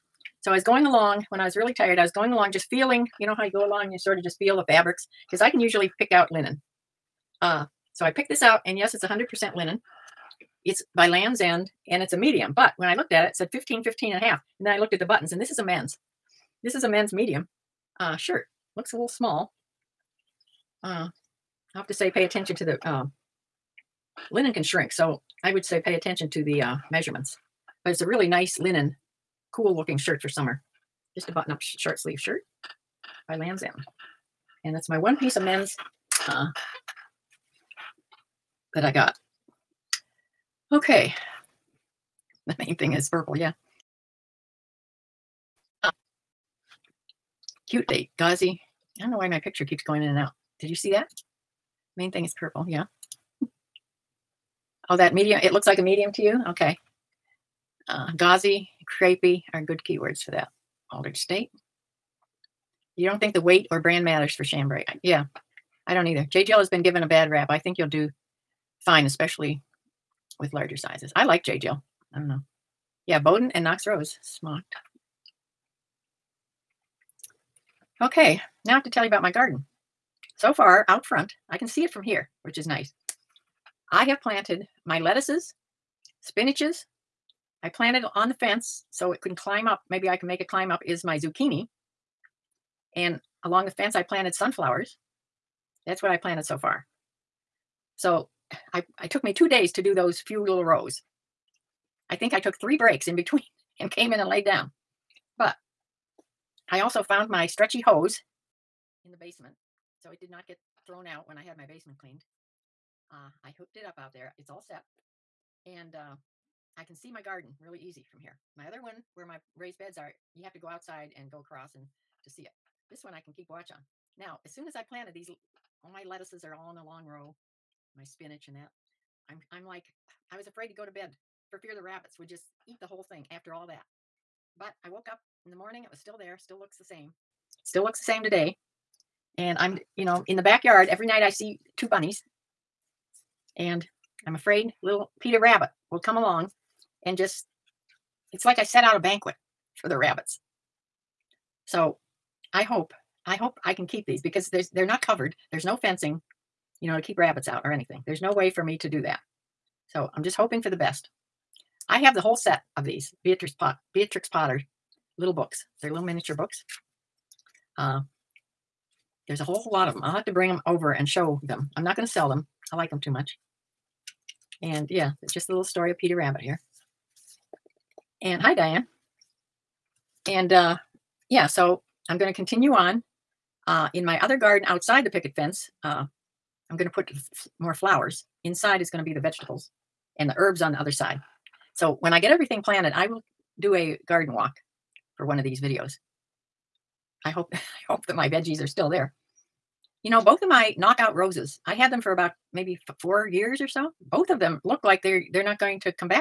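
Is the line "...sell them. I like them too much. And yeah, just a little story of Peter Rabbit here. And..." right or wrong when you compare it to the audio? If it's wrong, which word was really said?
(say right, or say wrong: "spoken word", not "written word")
right.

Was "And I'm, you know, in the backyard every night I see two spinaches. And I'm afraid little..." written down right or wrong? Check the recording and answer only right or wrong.
wrong.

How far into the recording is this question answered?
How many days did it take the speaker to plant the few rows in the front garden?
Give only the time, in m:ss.
1:39.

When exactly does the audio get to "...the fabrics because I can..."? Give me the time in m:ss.
0:04.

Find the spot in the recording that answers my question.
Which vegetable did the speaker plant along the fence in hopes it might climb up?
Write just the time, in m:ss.
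1:31.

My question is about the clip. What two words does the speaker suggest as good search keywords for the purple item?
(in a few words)
gauzy, crepey.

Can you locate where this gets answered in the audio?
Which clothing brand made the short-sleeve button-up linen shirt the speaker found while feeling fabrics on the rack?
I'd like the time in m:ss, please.
0:11.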